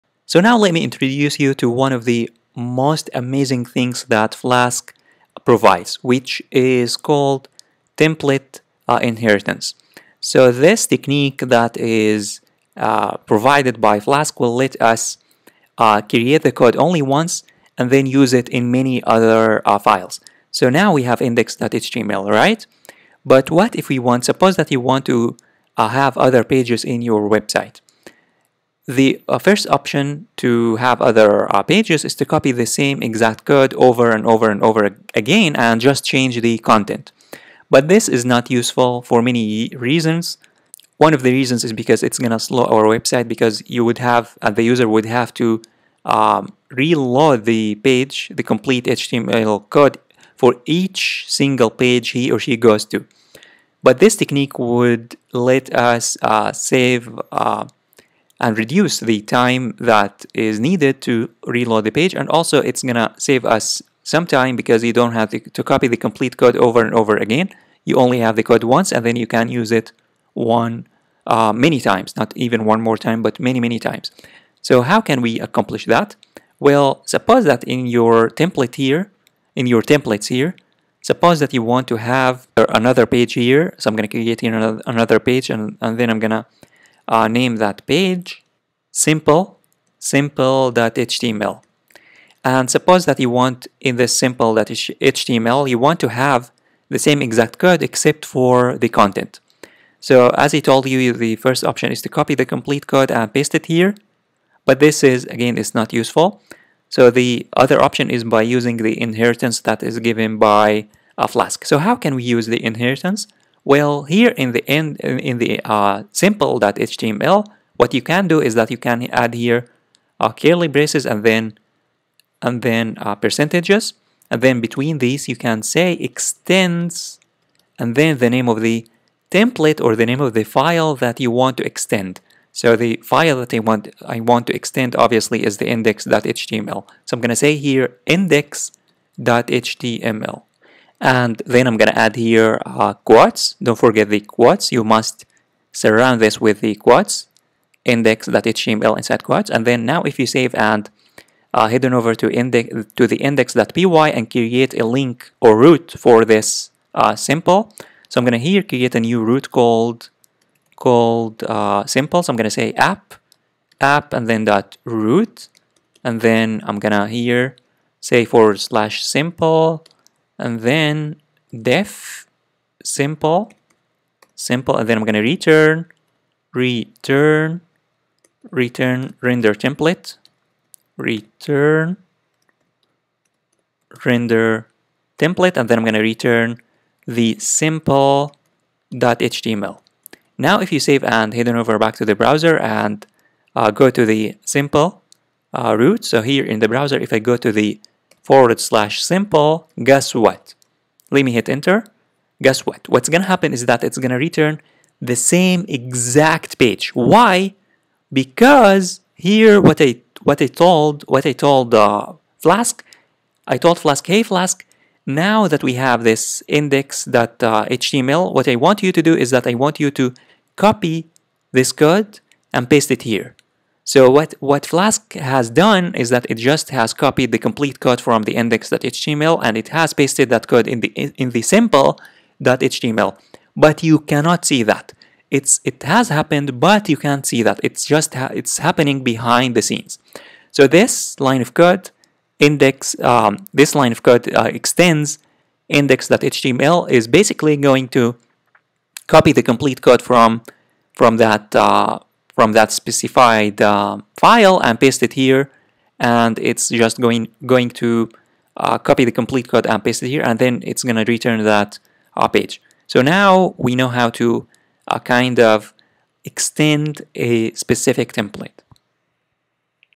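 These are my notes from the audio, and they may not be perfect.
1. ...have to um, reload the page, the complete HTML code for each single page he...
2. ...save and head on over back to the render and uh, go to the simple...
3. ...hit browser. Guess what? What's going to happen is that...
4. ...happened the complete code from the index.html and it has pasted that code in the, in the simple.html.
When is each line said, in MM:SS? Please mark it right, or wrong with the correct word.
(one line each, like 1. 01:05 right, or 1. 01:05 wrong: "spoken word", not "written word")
1. 00:45 right
2. 03:10 wrong: "browser", not "render"
3. 03:21 wrong: "enter", not "browser"
4. 03:46 wrong: "copied", not "happened".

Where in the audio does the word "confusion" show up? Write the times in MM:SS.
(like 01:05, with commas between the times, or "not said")
not said.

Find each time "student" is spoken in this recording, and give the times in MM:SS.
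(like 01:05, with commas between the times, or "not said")
not said.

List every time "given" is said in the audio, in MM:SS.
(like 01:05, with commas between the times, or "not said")
01:49.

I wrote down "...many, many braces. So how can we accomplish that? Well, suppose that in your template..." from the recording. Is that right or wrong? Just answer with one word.
wrong.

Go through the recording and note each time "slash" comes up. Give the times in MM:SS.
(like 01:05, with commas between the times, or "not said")
02:48, 03:18.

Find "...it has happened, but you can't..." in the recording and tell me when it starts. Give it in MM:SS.
03:55.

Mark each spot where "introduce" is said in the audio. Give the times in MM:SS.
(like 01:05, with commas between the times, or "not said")
00:00.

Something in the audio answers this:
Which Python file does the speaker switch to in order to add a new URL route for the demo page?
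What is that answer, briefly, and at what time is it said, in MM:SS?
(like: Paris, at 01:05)
index.py, at 02:33.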